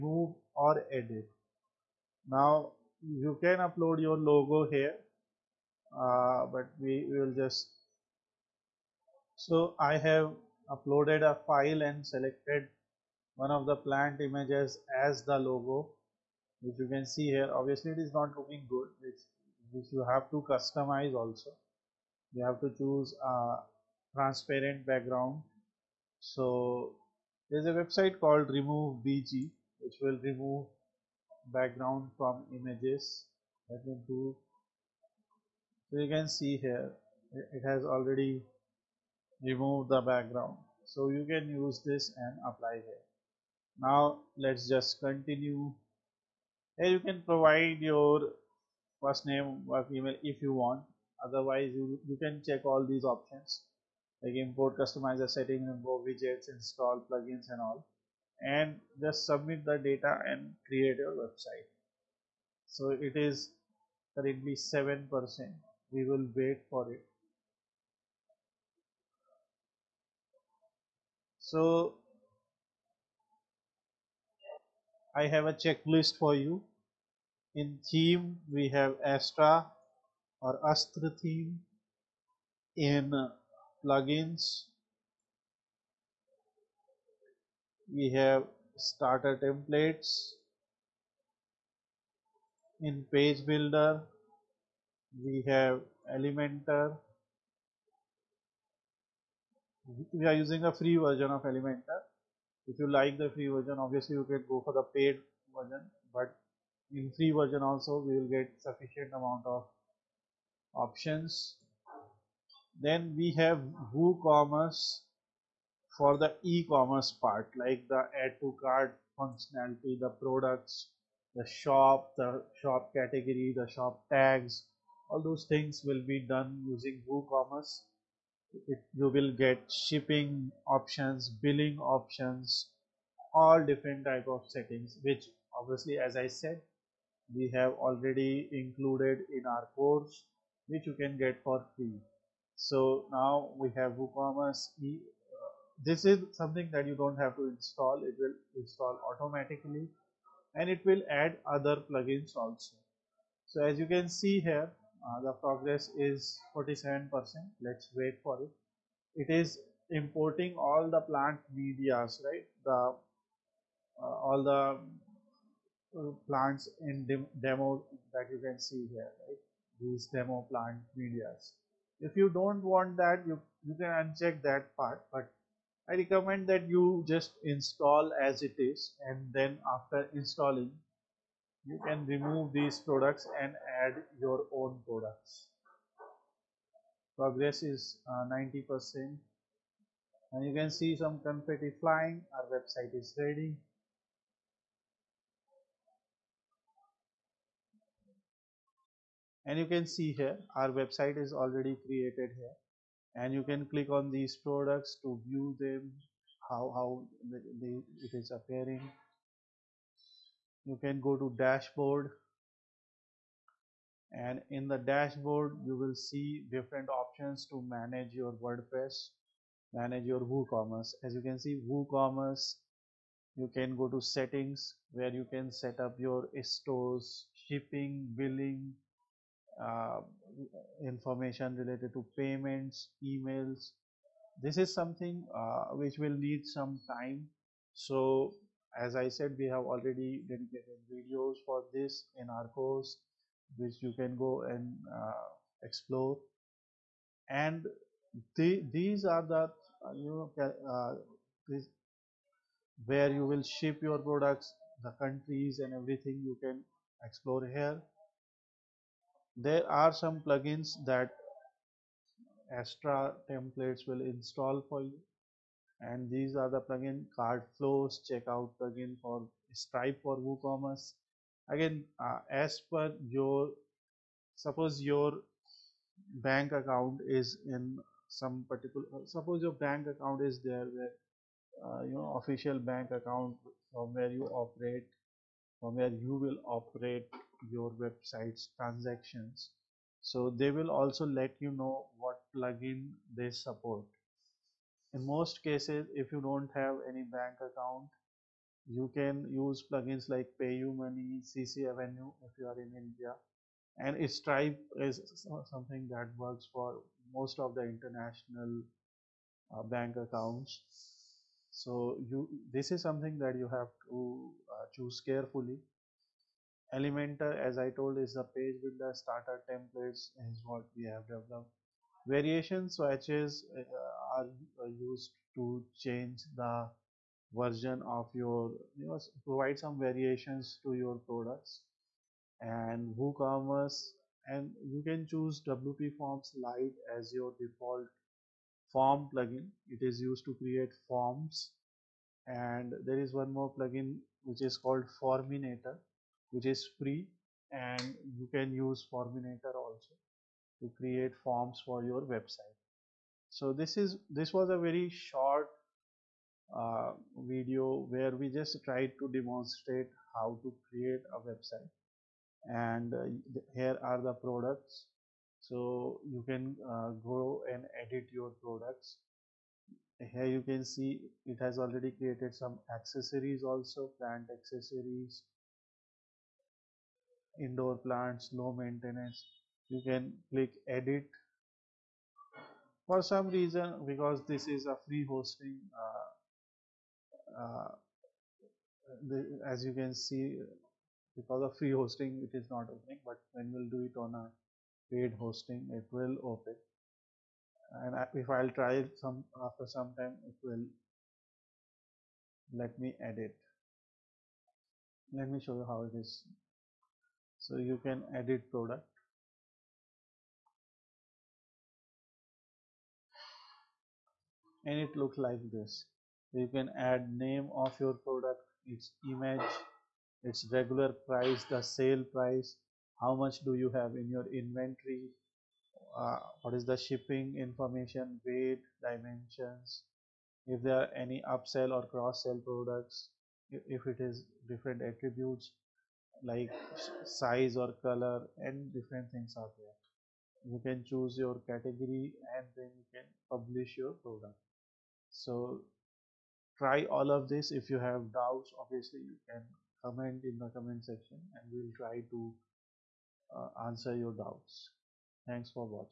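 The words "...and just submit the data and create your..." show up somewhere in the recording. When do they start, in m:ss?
0:58.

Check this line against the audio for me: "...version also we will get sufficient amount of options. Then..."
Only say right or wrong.
right.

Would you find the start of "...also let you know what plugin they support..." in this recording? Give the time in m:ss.
4:50.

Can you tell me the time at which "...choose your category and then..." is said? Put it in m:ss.
7:20.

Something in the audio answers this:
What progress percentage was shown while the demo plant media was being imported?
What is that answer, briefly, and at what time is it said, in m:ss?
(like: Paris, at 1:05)
47 percent, at 2:36.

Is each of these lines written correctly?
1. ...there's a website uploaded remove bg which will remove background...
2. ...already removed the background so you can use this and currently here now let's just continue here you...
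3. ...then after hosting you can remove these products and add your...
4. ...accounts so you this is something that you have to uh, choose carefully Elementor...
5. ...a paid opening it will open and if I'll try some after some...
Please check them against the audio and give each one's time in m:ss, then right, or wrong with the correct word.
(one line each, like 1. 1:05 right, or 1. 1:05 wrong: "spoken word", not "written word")
1. 0:27 wrong: "called", not "uploaded"
2. 0:37 wrong: "apply", not "currently"
3. 2:59 wrong: "installing", not "hosting"
4. 5:09 right
5. 6:34 wrong: "hosting", not "opening".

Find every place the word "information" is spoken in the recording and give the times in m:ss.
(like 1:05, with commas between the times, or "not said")
3:50, 7:07.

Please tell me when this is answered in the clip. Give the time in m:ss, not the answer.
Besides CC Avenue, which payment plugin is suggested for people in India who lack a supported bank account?
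5:00.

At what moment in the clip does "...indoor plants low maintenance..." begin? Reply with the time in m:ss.
6:17.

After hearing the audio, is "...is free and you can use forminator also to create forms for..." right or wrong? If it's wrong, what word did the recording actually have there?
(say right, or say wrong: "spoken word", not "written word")
right.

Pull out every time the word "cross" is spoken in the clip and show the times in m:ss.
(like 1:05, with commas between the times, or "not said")
7:11.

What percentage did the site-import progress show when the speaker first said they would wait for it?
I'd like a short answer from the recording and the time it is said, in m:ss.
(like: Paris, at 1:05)
7%, at 1:04.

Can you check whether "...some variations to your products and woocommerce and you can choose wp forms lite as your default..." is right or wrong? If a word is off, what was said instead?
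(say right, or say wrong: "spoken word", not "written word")
right.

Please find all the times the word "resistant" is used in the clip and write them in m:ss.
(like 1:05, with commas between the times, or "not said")
not said.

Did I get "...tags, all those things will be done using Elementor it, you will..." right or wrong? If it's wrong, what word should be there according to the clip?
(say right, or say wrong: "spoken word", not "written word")
wrong: "WooCommerce", not "Elementor".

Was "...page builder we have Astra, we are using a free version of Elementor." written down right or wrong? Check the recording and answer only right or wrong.
wrong.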